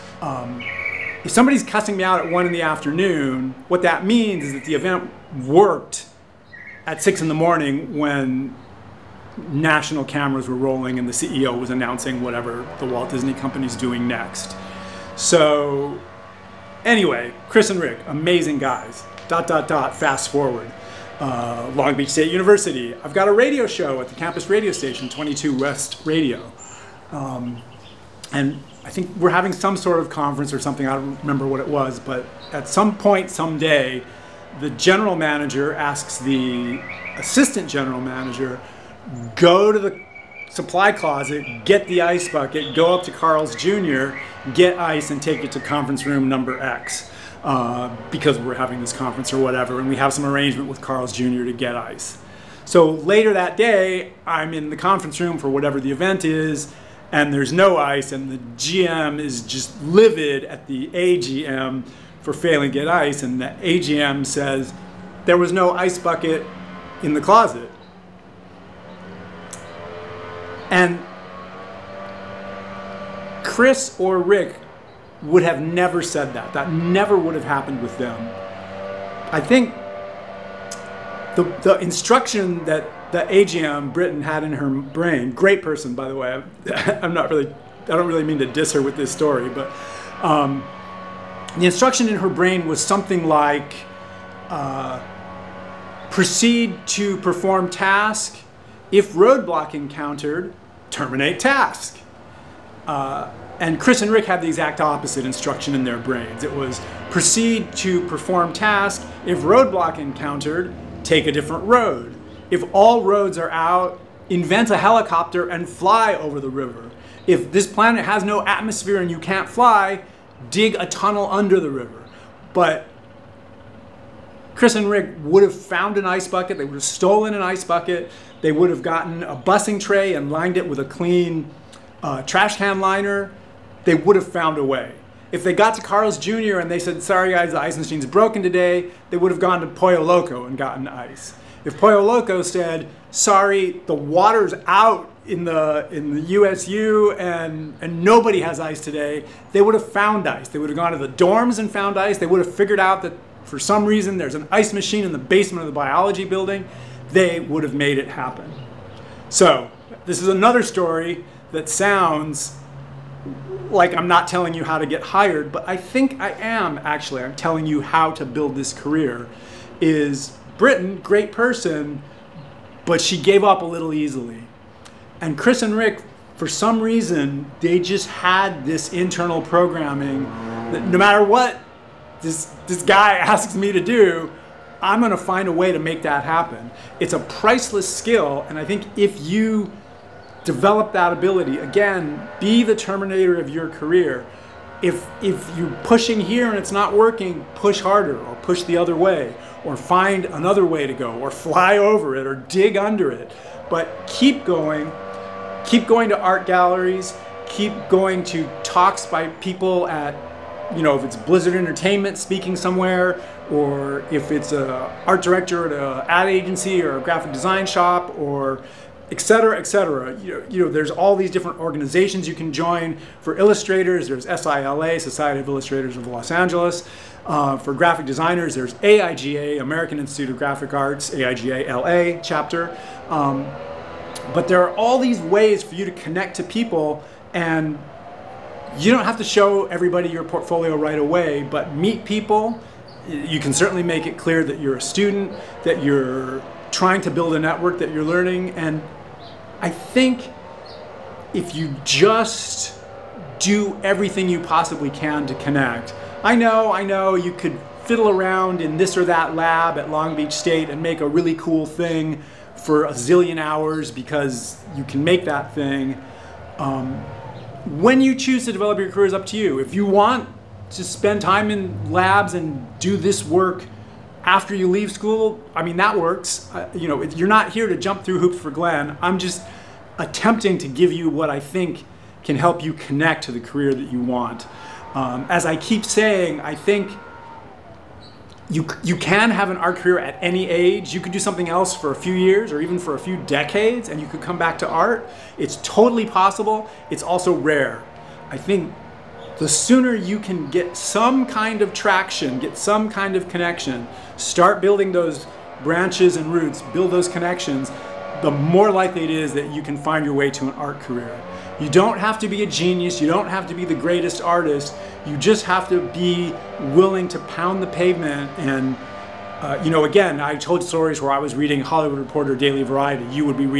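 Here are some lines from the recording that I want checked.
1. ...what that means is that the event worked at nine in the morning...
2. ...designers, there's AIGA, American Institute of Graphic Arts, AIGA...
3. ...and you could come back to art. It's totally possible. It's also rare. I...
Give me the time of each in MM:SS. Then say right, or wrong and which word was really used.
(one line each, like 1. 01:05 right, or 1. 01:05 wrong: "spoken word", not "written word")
1. 00:03 wrong: "six", not "nine"
2. 03:48 right
3. 04:53 right.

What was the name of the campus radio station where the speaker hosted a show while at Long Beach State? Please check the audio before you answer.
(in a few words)
22 West Radio.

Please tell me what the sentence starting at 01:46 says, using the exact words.
It was proceed to perform task.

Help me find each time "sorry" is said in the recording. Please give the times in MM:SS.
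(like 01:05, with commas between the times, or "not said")
02:17, 02:23.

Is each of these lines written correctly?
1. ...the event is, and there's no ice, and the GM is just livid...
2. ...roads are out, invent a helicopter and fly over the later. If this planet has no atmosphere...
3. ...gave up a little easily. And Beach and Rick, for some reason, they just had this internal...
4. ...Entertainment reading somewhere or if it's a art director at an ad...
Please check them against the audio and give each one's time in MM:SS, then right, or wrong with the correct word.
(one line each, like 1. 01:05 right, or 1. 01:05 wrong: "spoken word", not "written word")
1. 00:55 right
2. 01:53 wrong: "river", not "later"
3. 02:53 wrong: "Chris", not "Beach"
4. 03:31 wrong: "speaking", not "reading".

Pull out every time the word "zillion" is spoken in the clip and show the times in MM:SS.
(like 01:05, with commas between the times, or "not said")
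04:22.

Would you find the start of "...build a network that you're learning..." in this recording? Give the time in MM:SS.
04:07.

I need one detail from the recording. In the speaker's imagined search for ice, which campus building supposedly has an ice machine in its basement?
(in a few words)
the biology building.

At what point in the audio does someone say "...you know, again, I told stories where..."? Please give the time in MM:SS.
05:19.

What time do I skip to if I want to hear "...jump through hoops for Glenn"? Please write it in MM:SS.
04:37.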